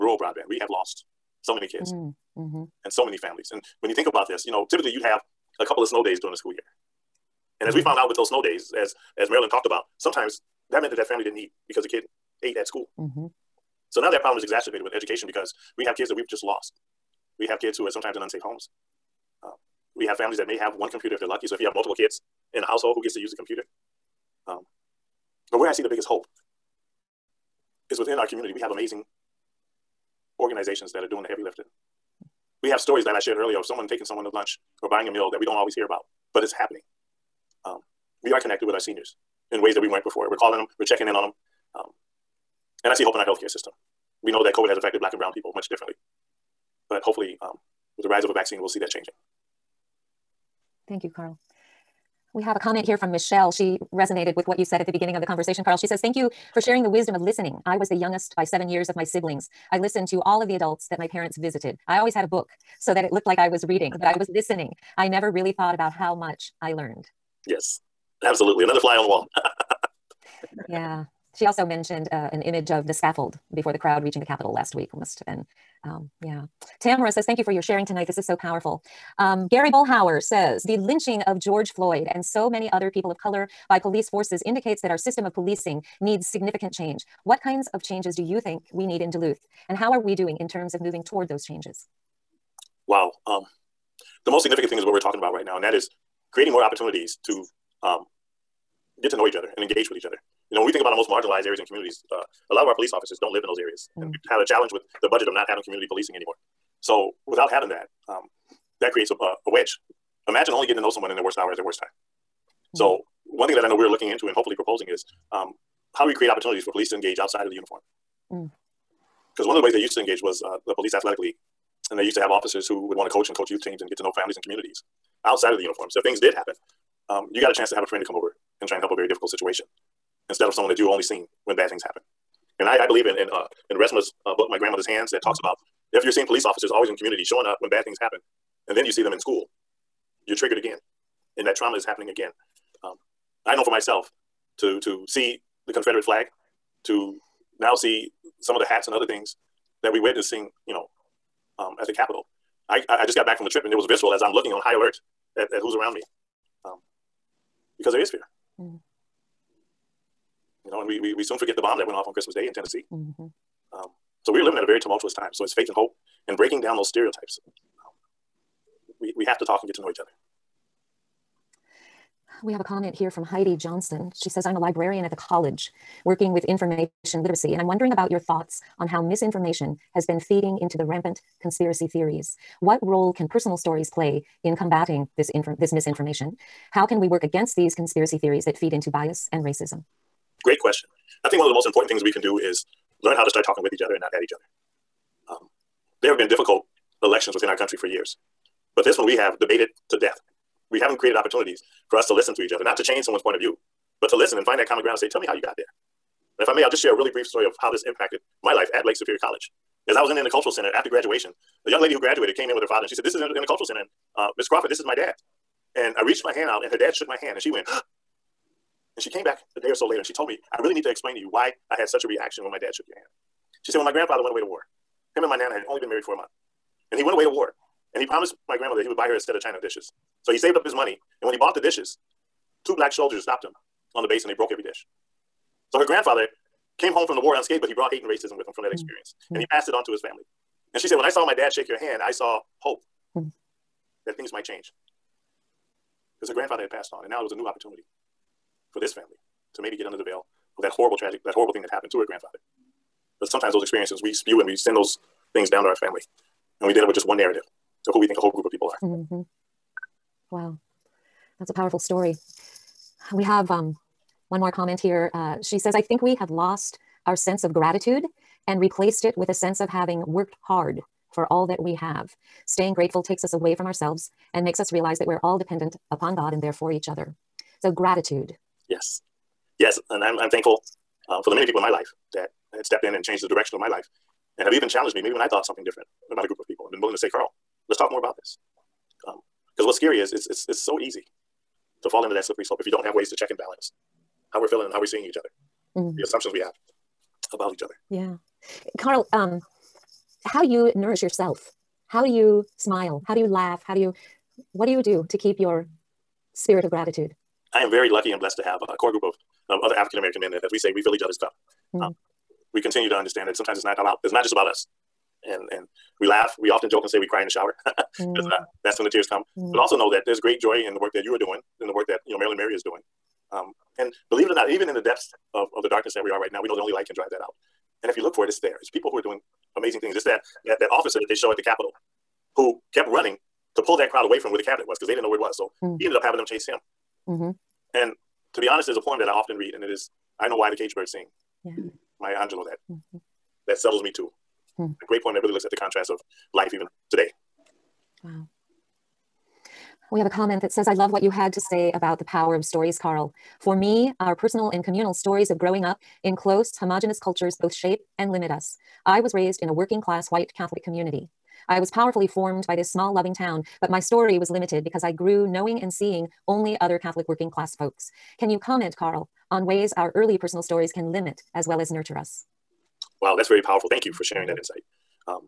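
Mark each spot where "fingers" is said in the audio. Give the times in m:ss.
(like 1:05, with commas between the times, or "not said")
not said.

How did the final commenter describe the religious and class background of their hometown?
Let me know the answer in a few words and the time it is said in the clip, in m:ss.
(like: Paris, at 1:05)
Working class white Catholic, at 5:59.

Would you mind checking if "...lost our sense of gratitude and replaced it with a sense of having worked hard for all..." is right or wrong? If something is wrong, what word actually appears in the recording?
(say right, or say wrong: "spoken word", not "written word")
right.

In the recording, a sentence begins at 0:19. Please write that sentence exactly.
Uh, we have families that may have one computer if they're lucky.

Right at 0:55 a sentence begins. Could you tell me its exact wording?
She says, Thank you for sharing the wisdom of listening.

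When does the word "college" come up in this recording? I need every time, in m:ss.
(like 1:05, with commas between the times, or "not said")
2:55, 3:29.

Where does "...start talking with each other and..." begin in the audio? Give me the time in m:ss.
3:13.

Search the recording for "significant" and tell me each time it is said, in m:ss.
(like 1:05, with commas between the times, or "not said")
1:26, 1:34.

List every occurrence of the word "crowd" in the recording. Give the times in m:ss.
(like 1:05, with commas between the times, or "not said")
1:13, 5:33.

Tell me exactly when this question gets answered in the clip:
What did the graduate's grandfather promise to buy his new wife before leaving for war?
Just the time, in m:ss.
3:49.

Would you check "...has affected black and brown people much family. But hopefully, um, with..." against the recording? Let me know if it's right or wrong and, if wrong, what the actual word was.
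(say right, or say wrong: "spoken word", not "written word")
wrong: "differently", not "family".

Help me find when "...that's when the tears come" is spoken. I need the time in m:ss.
5:18.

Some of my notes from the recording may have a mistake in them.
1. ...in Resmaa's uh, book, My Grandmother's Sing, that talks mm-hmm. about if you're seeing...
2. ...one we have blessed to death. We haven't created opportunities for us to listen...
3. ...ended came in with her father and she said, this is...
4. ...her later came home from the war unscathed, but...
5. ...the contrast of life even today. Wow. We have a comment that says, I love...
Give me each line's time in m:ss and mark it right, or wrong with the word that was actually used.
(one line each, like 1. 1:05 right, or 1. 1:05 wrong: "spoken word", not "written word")
1. 2:13 wrong: "Hands", not "Sing"
2. 3:18 wrong: "debated", not "blessed"
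3. 3:31 wrong: "graduated", not "ended"
4. 3:55 wrong: "grandfather", not "later"
5. 5:45 right.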